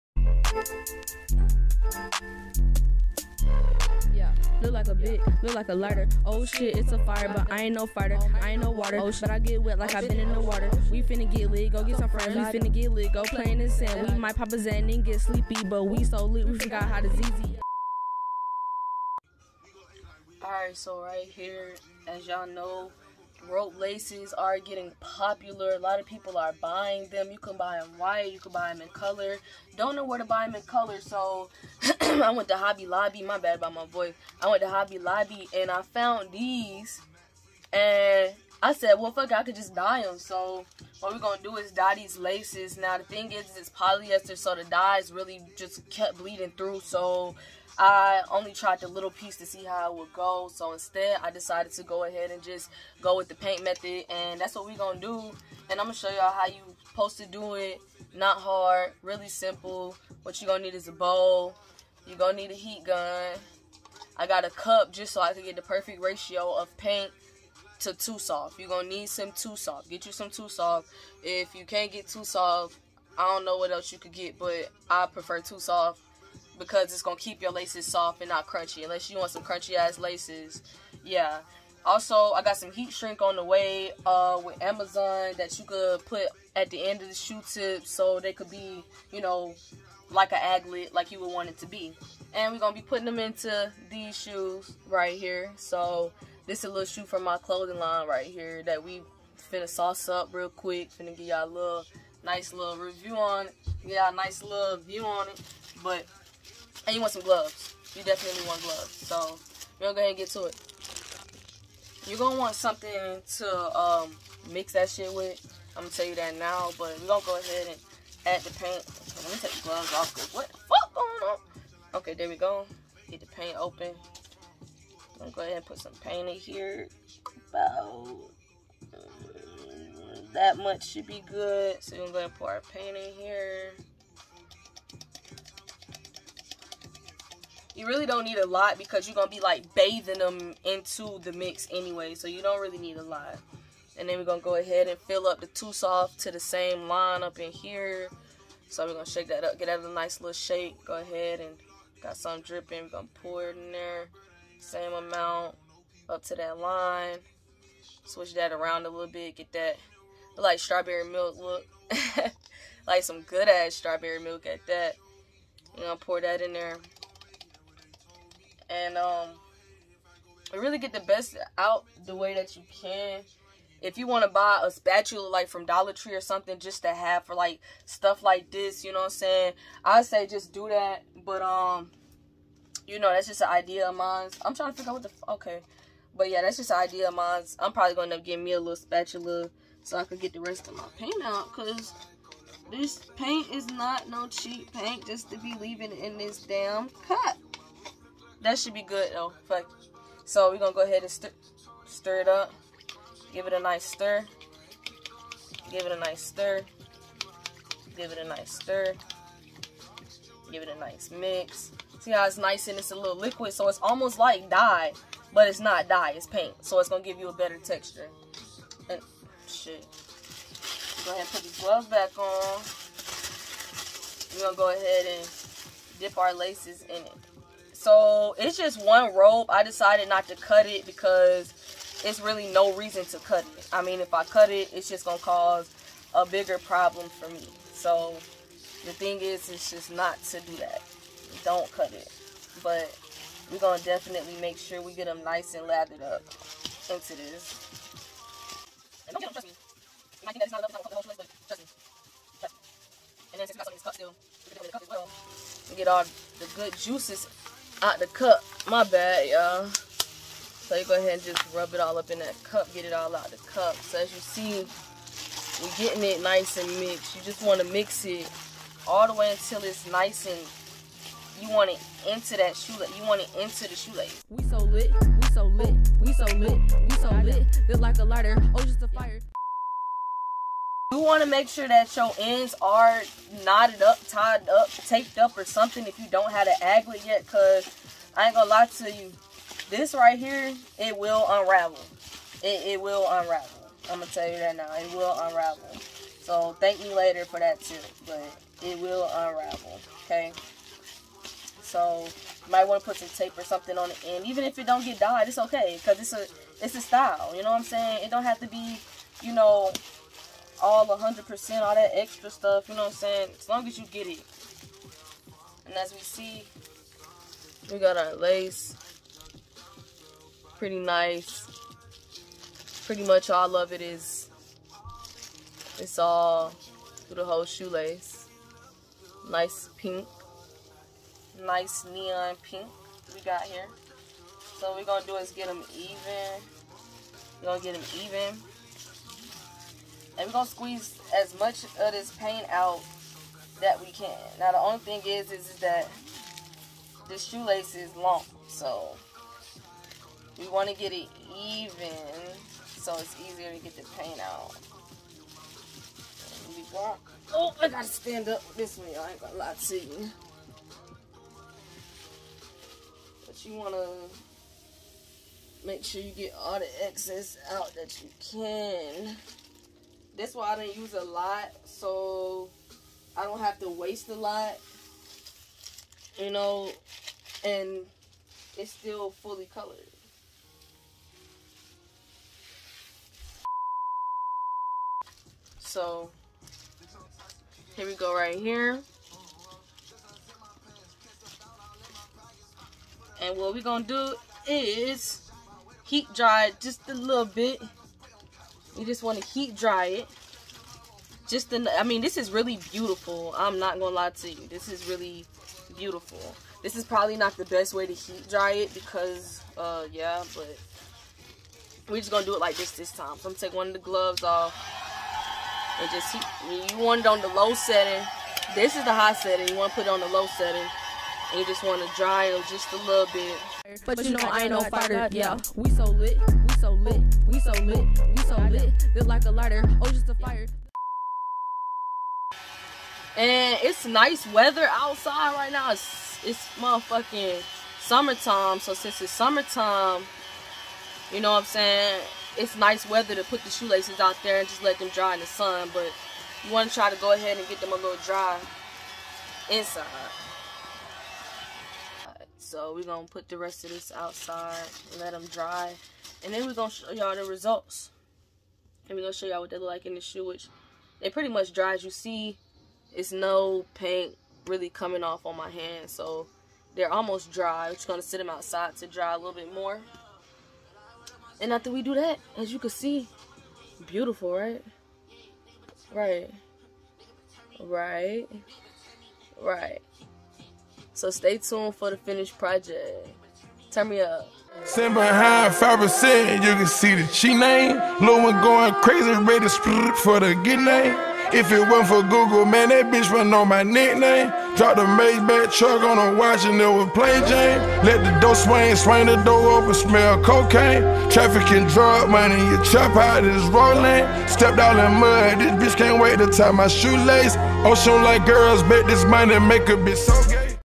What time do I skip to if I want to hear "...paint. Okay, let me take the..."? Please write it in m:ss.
1:58.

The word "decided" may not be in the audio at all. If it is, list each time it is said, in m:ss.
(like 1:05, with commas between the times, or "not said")
0:51, 3:49.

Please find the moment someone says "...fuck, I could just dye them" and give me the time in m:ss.
0:39.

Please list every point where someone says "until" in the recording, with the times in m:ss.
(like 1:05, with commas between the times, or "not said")
4:29.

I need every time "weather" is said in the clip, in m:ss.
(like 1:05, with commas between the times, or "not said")
7:14, 7:22.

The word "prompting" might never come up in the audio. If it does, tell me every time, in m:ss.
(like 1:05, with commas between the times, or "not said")
not said.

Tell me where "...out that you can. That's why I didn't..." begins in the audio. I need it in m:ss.
6:07.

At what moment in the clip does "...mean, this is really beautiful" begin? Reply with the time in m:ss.
6:41.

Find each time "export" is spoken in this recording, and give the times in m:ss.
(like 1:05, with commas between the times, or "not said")
not said.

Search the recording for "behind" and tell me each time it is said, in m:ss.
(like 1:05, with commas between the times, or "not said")
8:04.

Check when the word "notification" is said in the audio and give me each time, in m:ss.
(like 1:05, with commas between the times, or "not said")
not said.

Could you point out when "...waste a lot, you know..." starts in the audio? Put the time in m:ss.
6:13.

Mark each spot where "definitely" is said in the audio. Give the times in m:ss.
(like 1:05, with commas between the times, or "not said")
1:48, 4:03.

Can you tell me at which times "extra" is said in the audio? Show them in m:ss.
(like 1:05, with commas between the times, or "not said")
5:11.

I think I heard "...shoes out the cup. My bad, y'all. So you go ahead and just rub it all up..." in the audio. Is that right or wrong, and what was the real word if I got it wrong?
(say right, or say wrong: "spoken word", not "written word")
wrong: "juices", not "shoes".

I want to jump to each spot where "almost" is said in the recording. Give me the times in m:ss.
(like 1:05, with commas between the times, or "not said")
3:33, 7:46.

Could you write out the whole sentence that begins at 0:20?
Alright, so right here, as y'all know, rope laces are getting popular.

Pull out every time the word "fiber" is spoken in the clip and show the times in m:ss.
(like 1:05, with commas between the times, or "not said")
not said.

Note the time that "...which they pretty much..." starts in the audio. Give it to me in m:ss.
7:40.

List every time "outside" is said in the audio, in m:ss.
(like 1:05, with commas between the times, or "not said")
7:14, 7:33, 7:48.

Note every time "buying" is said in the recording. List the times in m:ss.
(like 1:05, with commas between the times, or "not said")
0:26.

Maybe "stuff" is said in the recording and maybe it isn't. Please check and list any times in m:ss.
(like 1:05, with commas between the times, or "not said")
2:57, 5:12.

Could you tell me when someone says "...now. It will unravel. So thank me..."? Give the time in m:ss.
4:54.